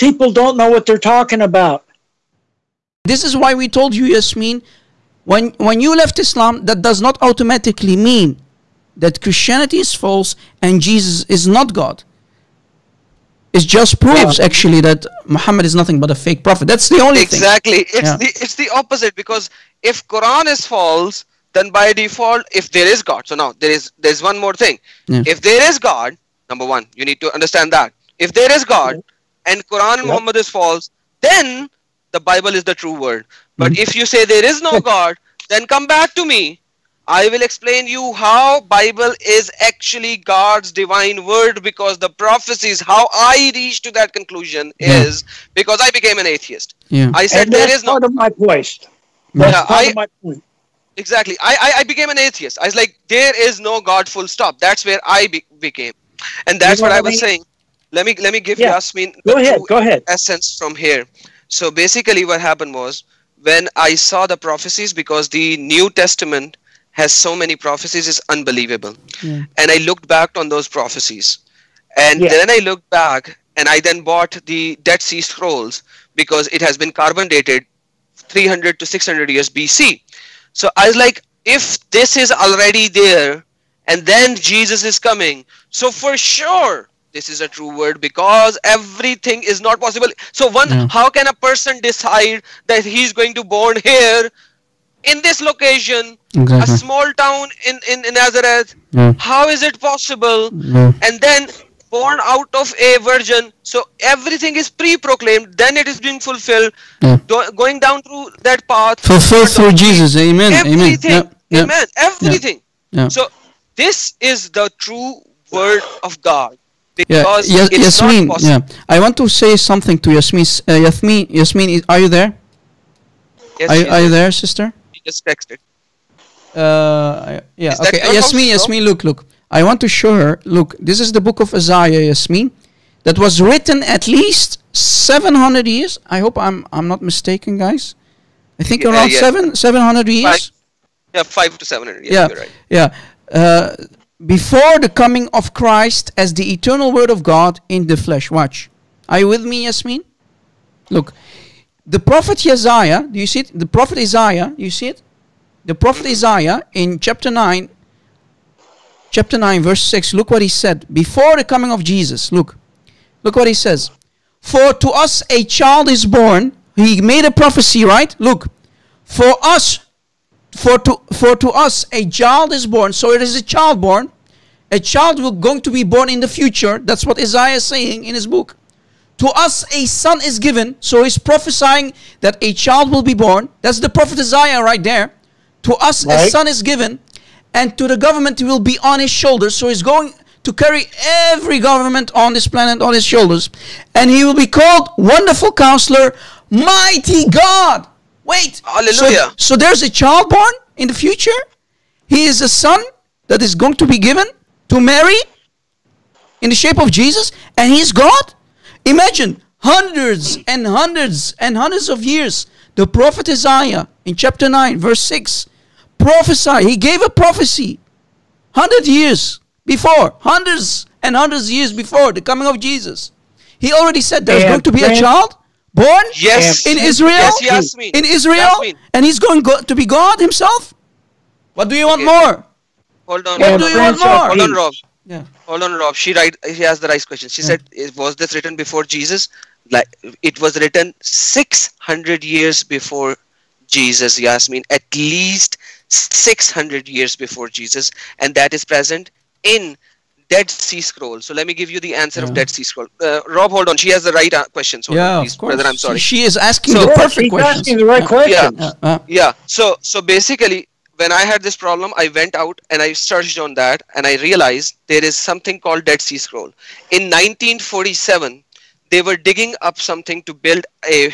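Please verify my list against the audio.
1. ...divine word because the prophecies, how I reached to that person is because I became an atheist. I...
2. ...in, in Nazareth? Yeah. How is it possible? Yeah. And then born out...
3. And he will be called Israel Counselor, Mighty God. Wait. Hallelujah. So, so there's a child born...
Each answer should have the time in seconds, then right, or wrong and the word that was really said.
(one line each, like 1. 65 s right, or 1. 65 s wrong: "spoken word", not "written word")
1. 40 s wrong: "conclusion", not "person"
2. 97 s right
3. 193 s wrong: "Wonderful", not "Israel".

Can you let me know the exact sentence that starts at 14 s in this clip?
actually that Muhammad is nothing but a fake prophet.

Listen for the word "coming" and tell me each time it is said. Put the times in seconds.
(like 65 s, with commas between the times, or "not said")
84 s, 144 s, 161 s, 222 s.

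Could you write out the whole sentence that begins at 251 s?
So let me give you the answer yeah.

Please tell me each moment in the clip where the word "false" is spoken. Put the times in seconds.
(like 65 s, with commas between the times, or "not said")
9 s, 20 s, 30 s.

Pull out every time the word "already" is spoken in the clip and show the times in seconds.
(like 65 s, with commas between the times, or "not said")
82 s, 223 s.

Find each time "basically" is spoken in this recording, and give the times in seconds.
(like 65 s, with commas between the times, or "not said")
61 s, 260 s.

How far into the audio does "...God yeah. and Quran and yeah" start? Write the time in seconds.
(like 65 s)
28 s.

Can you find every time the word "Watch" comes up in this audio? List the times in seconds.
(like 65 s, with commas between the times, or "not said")
148 s.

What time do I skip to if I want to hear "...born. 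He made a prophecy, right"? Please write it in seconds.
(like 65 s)
166 s.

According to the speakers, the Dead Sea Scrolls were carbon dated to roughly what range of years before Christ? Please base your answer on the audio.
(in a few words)
300 to 600 years BC.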